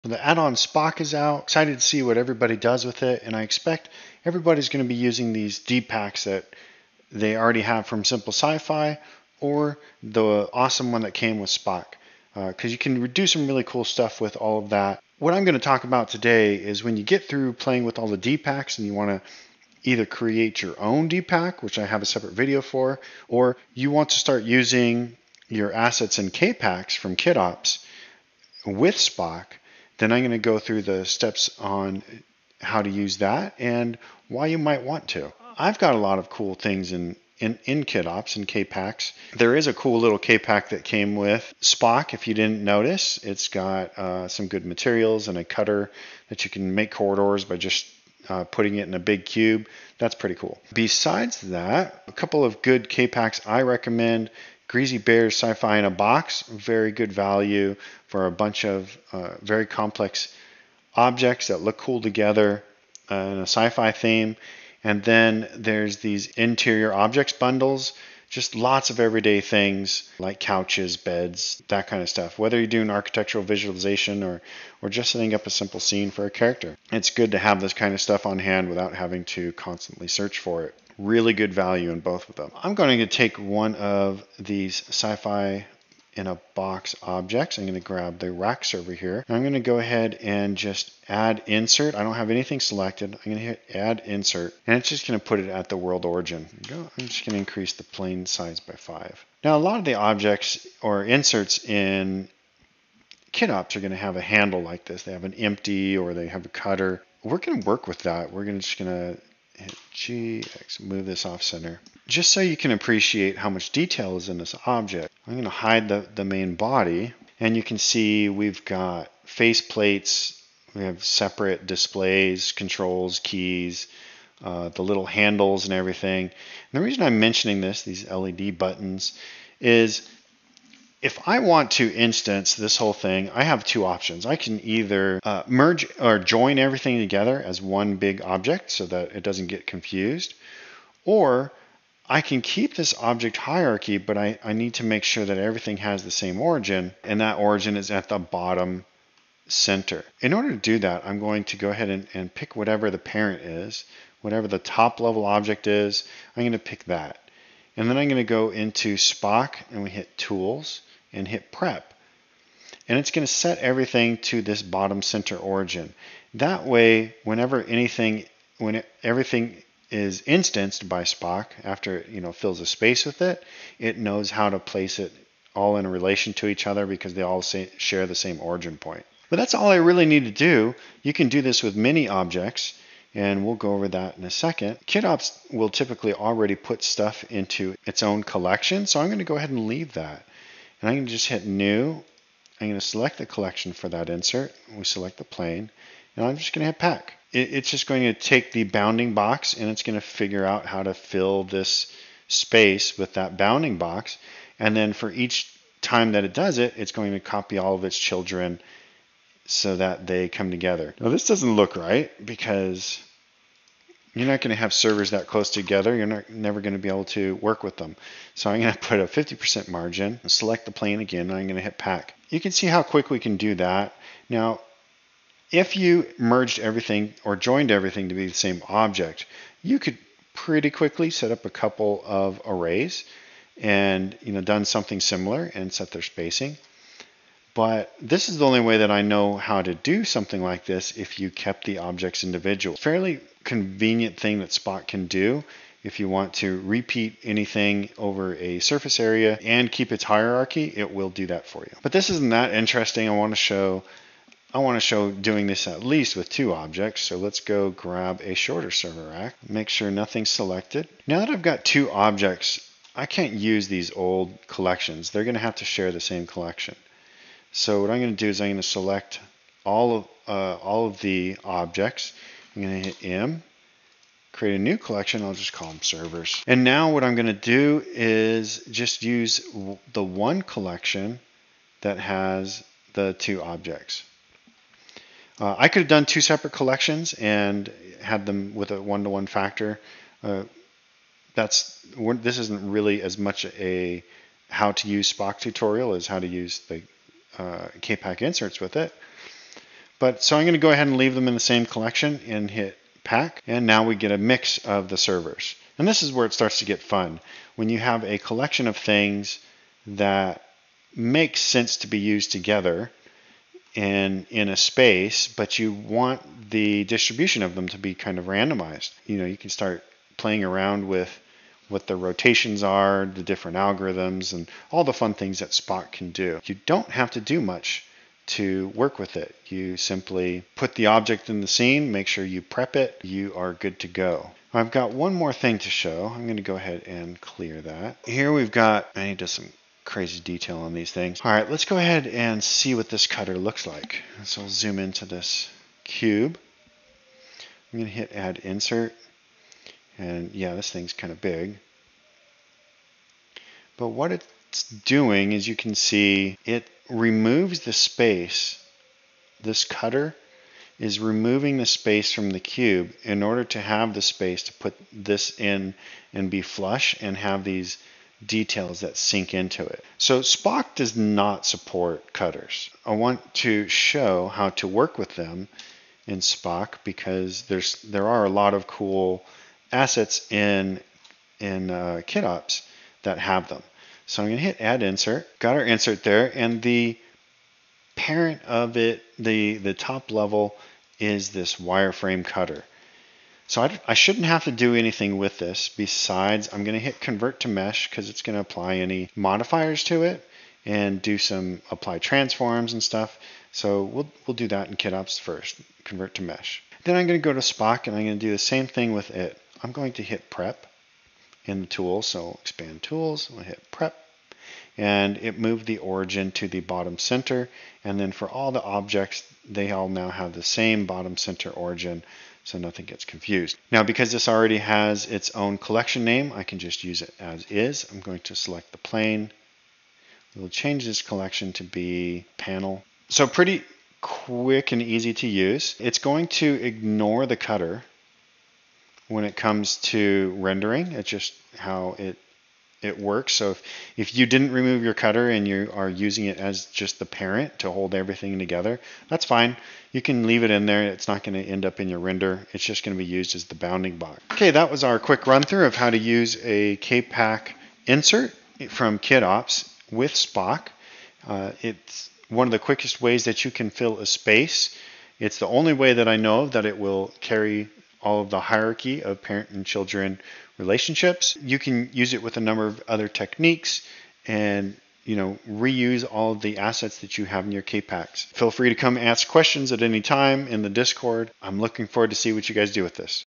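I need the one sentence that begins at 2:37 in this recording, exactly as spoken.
And then I'm going to go into Spock and we hit Tools and hit prep.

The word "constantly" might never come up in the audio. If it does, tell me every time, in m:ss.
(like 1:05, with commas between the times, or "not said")
1:19.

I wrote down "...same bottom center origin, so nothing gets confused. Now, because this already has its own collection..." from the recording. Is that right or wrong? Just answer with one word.
right.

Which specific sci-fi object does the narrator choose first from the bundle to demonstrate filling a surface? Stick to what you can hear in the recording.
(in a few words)
rack server.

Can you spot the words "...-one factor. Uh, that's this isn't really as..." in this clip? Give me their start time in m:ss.
4:49.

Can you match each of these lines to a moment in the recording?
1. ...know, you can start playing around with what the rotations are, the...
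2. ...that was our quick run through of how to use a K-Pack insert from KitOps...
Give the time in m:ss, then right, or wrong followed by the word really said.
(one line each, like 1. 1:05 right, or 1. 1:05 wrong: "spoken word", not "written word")
1. 5:19 right
2. 7:34 right.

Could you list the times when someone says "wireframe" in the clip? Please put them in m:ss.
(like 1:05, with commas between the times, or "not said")
6:31.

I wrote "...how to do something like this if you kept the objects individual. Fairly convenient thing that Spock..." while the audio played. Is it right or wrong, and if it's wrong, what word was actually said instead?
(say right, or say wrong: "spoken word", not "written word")
right.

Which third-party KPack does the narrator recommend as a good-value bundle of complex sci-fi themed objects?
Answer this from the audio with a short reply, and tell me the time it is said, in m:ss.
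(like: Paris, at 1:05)
Sci Fi in a Box, at 0:55.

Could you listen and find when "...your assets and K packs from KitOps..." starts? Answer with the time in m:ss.
0:25.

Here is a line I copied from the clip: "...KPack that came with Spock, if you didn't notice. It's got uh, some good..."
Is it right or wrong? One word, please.
right.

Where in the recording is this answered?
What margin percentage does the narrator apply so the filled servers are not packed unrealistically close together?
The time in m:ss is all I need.
3:39.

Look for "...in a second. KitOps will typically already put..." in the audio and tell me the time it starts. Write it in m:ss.
3:04.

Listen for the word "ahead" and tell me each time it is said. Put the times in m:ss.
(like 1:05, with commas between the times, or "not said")
1:29, 2:31, 3:09, 5:00, 5:36, 5:41.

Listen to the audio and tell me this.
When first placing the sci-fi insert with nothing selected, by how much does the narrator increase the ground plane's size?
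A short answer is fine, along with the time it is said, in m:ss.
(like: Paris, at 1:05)
5, at 1:38.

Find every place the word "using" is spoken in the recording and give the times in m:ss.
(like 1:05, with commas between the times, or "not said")
0:04, 0:24, 7:25.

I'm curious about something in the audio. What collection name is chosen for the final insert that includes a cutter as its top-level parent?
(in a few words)
panel.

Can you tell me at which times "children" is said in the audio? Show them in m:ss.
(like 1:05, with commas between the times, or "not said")
3:27, 7:49.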